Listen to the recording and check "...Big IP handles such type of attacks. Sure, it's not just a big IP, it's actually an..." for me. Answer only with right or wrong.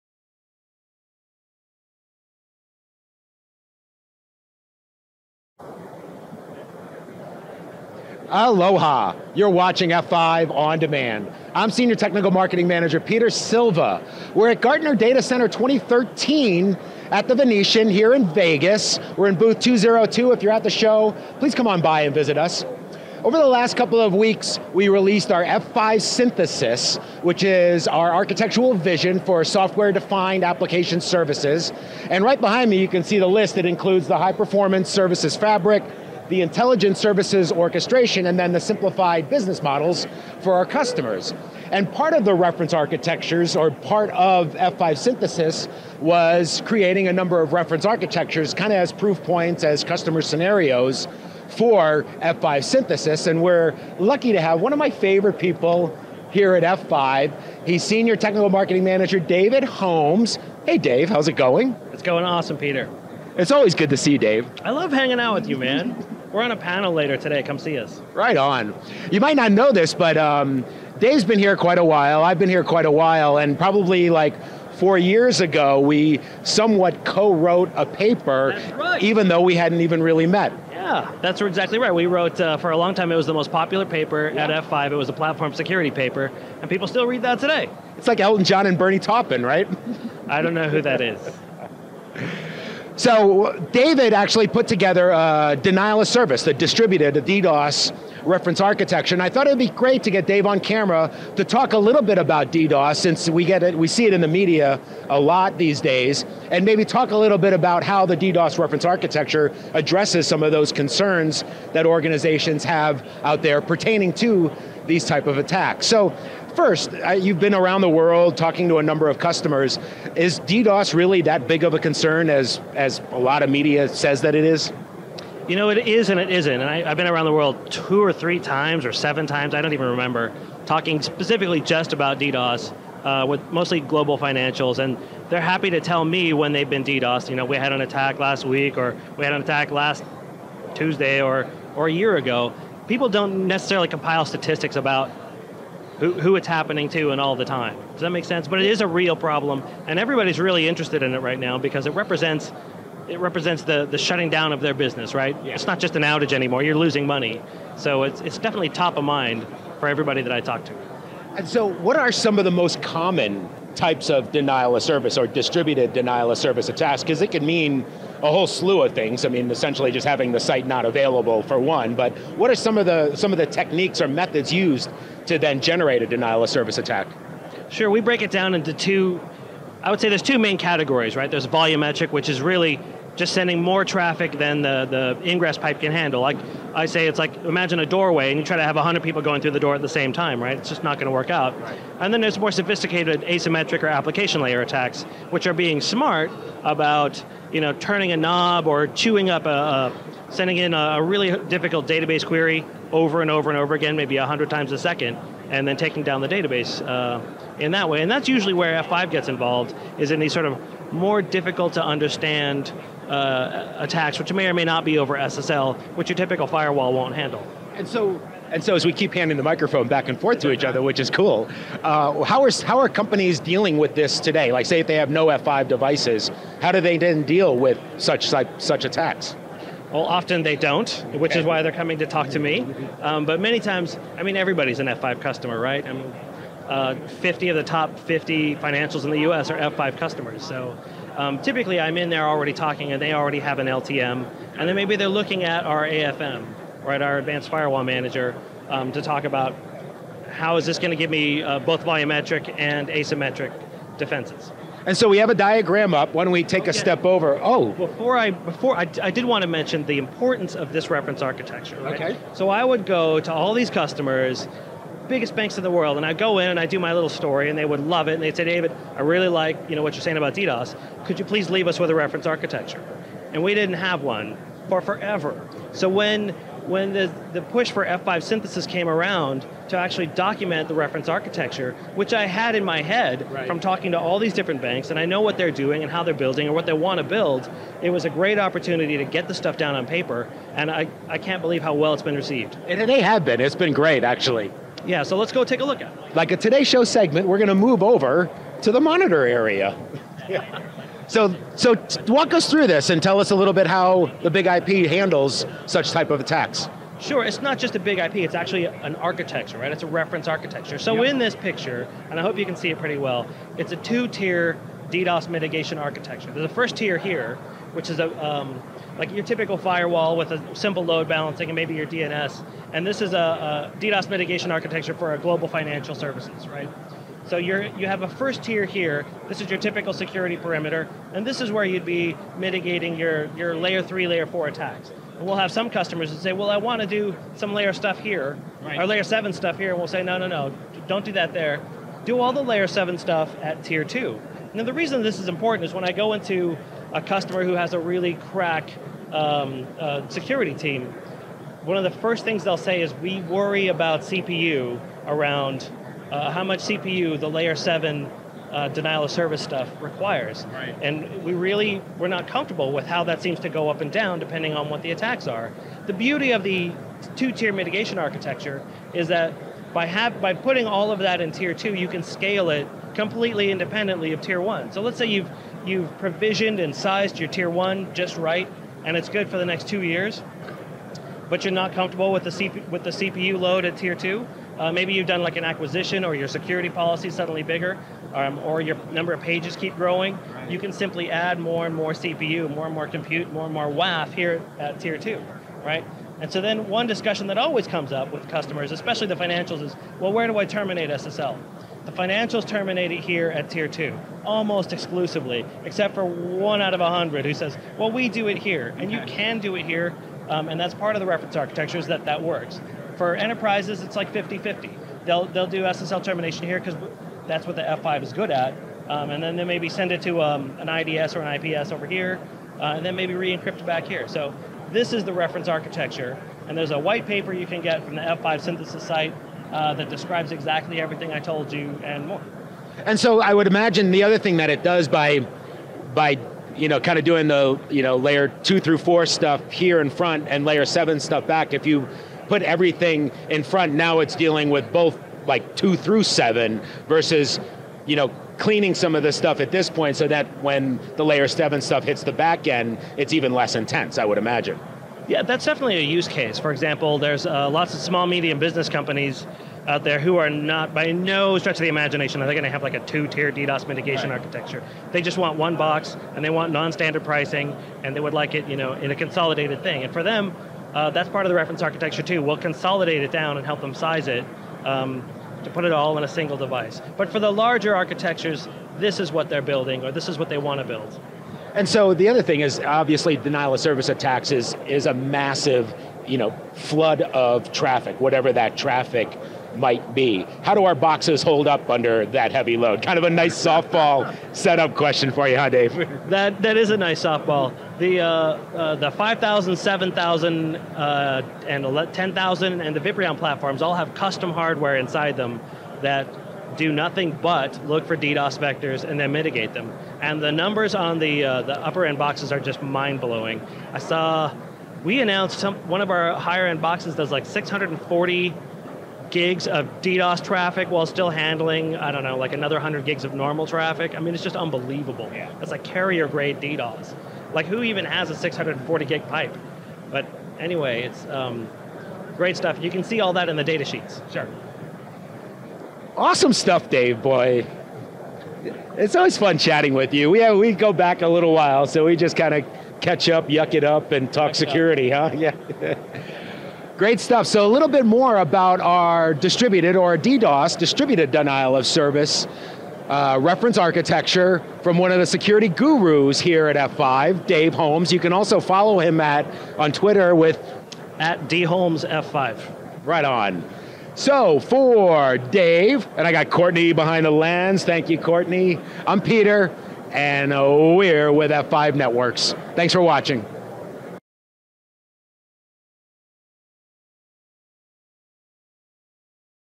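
right.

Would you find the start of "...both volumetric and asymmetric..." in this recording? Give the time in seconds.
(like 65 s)
251 s.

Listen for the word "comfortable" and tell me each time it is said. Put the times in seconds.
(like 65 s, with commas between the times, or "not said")
362 s, 381 s.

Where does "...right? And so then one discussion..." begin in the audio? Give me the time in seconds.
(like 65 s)
395 s.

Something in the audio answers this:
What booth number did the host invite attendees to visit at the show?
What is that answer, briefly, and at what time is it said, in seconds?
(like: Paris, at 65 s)
202, at 19 s.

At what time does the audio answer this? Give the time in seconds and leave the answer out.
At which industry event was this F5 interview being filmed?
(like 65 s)
14 s.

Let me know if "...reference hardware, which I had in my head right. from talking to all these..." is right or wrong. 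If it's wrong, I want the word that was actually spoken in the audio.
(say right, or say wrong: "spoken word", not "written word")
wrong: "architecture", not "hardware".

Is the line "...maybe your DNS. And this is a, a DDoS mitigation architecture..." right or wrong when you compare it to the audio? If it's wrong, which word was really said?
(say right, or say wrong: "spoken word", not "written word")
right.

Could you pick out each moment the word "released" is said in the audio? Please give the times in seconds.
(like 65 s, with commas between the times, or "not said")
24 s.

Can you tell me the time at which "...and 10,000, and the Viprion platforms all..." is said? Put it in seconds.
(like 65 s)
501 s.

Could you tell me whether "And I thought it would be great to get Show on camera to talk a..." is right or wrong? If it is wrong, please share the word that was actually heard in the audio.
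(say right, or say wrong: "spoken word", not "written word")
wrong: "Dave", not "Show".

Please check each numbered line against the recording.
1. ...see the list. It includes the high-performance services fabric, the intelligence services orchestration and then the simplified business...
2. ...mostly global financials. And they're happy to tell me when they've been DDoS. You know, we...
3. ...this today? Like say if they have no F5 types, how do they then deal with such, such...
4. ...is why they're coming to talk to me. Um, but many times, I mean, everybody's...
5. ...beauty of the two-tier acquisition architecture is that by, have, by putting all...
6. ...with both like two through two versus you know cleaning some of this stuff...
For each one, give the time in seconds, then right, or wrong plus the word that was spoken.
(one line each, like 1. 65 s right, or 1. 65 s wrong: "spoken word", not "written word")
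1. 33 s right
2. 133 s right
3. 223 s wrong: "devices", not "types"
4. 231 s right
5. 365 s wrong: "mitigation", not "acquisition"
6. 444 s wrong: "seven", not "two".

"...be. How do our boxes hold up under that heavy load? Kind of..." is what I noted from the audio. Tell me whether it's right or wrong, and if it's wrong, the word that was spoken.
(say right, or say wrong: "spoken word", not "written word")
right.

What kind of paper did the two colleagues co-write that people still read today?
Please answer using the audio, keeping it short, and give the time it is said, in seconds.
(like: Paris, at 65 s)
platform security paper, at 85 s.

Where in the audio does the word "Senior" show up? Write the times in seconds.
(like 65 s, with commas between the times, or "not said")
11 s, 57 s.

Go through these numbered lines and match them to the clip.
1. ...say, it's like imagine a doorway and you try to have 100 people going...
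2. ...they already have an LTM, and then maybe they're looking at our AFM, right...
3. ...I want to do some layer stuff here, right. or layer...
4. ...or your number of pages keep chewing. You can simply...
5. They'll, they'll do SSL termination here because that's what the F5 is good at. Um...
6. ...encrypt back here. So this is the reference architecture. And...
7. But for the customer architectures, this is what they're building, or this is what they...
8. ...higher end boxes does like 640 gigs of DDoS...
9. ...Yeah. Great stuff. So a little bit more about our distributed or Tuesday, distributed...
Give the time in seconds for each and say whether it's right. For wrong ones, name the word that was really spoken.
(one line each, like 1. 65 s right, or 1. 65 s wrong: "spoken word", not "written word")
1. 186 s right
2. 242 s right
3. 336 s right
4. 388 s wrong: "growing", not "chewing"
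5. 415 s right
6. 423 s right
7. 476 s wrong: "larger", not "customer"
8. 516 s right
9. 545 s wrong: "DDoS", not "Tuesday".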